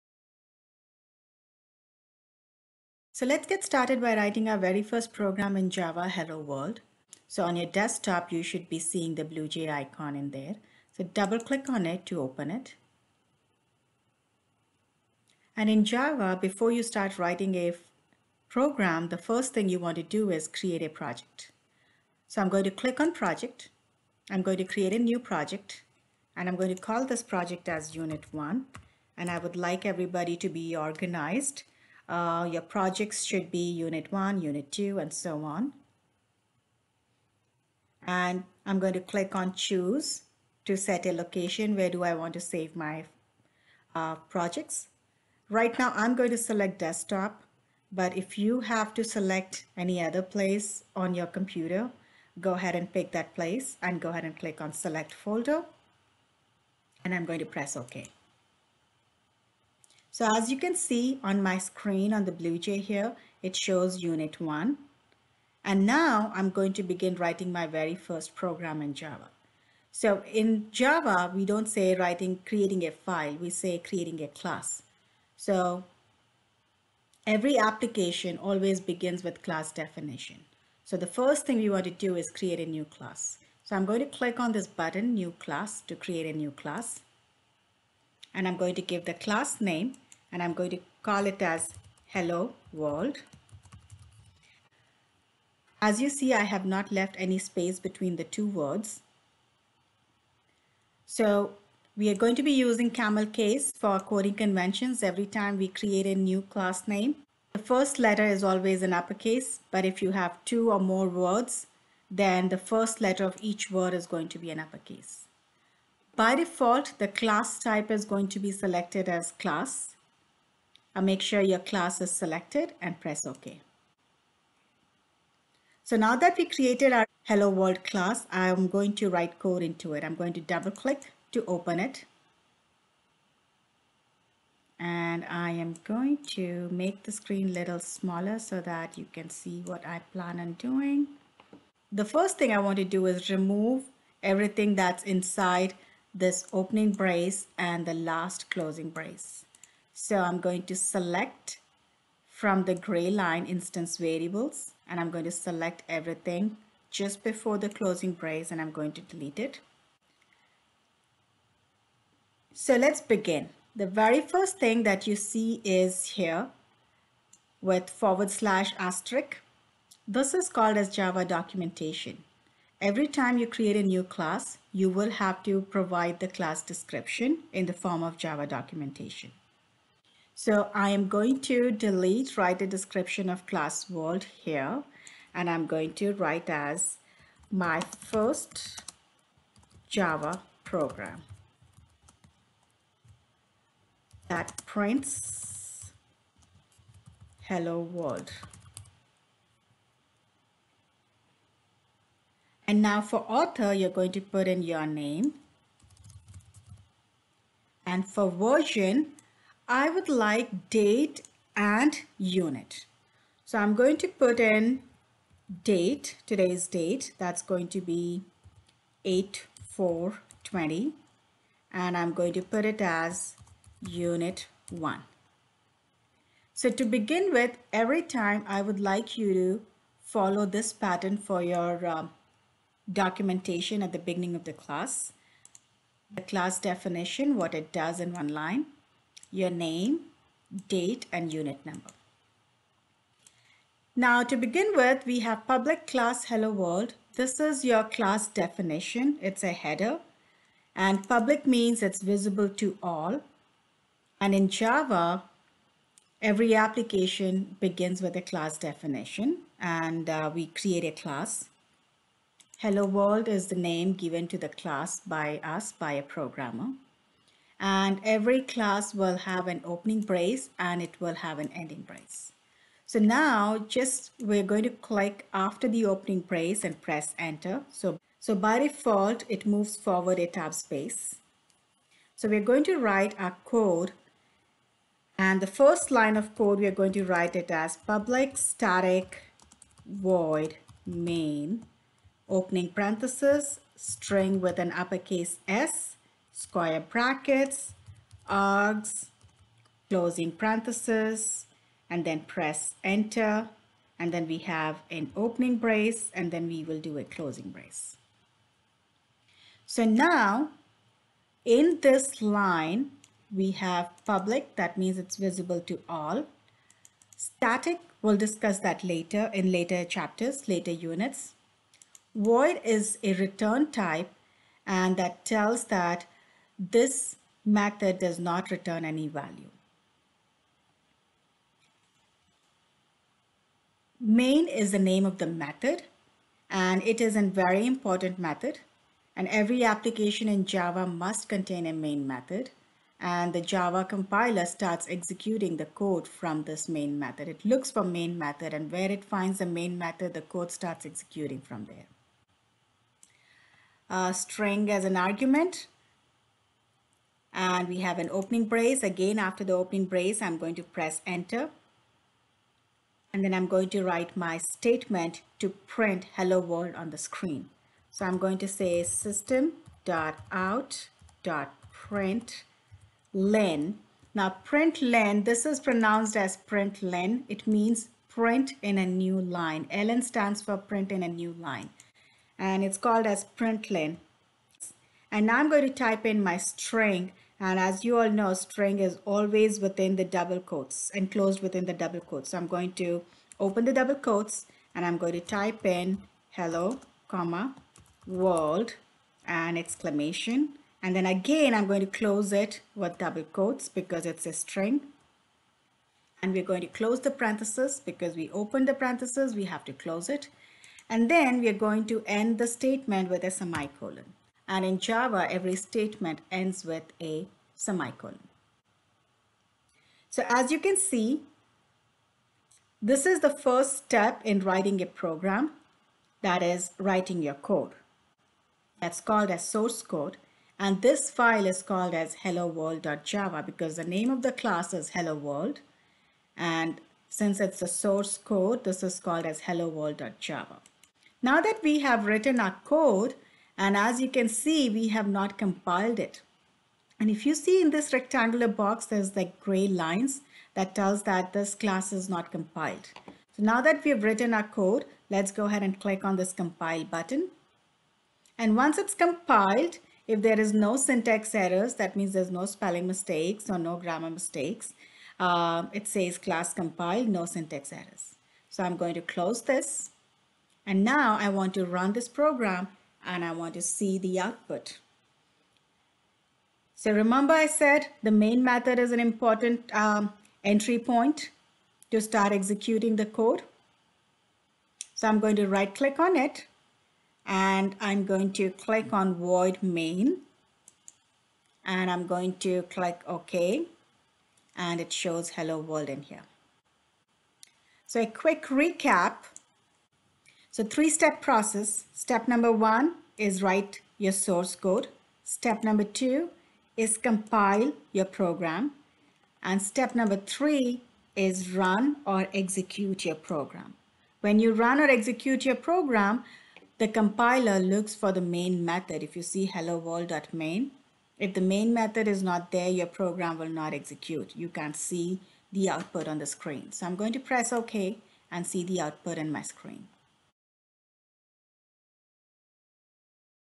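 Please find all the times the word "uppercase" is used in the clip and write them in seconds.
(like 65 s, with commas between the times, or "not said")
108 s, 114 s, 294 s.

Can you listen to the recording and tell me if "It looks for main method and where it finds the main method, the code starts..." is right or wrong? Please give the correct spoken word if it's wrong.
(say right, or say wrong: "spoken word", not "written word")
right.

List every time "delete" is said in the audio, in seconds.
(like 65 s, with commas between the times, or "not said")
159 s, 181 s.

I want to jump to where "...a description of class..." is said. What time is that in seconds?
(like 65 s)
182 s.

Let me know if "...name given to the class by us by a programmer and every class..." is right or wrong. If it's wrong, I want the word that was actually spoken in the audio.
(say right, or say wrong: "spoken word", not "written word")
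right.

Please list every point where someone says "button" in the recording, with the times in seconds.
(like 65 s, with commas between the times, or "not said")
84 s, 456 s.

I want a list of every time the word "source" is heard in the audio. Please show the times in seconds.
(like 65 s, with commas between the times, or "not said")
429 s, 437 s, 504 s.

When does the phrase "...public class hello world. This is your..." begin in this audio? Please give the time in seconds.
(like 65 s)
245 s.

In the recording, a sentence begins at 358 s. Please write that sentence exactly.
Again, after the opening brace, I'm going to press enter.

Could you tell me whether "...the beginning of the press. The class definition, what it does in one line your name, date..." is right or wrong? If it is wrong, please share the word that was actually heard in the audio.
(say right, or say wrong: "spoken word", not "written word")
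wrong: "class", not "press".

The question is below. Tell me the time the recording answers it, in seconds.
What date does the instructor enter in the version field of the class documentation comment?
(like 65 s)
219 s.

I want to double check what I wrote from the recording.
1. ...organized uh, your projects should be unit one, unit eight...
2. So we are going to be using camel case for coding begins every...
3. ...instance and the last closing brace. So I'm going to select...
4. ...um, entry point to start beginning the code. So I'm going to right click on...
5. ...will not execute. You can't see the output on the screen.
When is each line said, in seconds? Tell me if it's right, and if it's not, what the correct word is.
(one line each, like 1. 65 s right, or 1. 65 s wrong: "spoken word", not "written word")
1. 30 s wrong: "two", not "eight"
2. 101 s wrong: "conventions", not "begins"
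3. 146 s wrong: "brace", not "instance"
4. 479 s wrong: "executing", not "beginning"
5. 523 s right.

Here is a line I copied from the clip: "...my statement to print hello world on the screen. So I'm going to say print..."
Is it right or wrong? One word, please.
right.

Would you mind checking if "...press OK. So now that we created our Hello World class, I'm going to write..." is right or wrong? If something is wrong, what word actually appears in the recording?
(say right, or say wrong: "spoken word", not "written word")
right.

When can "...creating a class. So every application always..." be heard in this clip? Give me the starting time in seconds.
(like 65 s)
73 s.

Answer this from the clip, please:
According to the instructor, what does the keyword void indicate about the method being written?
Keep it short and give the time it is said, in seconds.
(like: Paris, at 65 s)
return type, at 323 s.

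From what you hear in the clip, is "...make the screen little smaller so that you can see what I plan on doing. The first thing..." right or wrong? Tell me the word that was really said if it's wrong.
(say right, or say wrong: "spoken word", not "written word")
right.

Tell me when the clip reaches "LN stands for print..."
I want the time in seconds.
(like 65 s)
379 s.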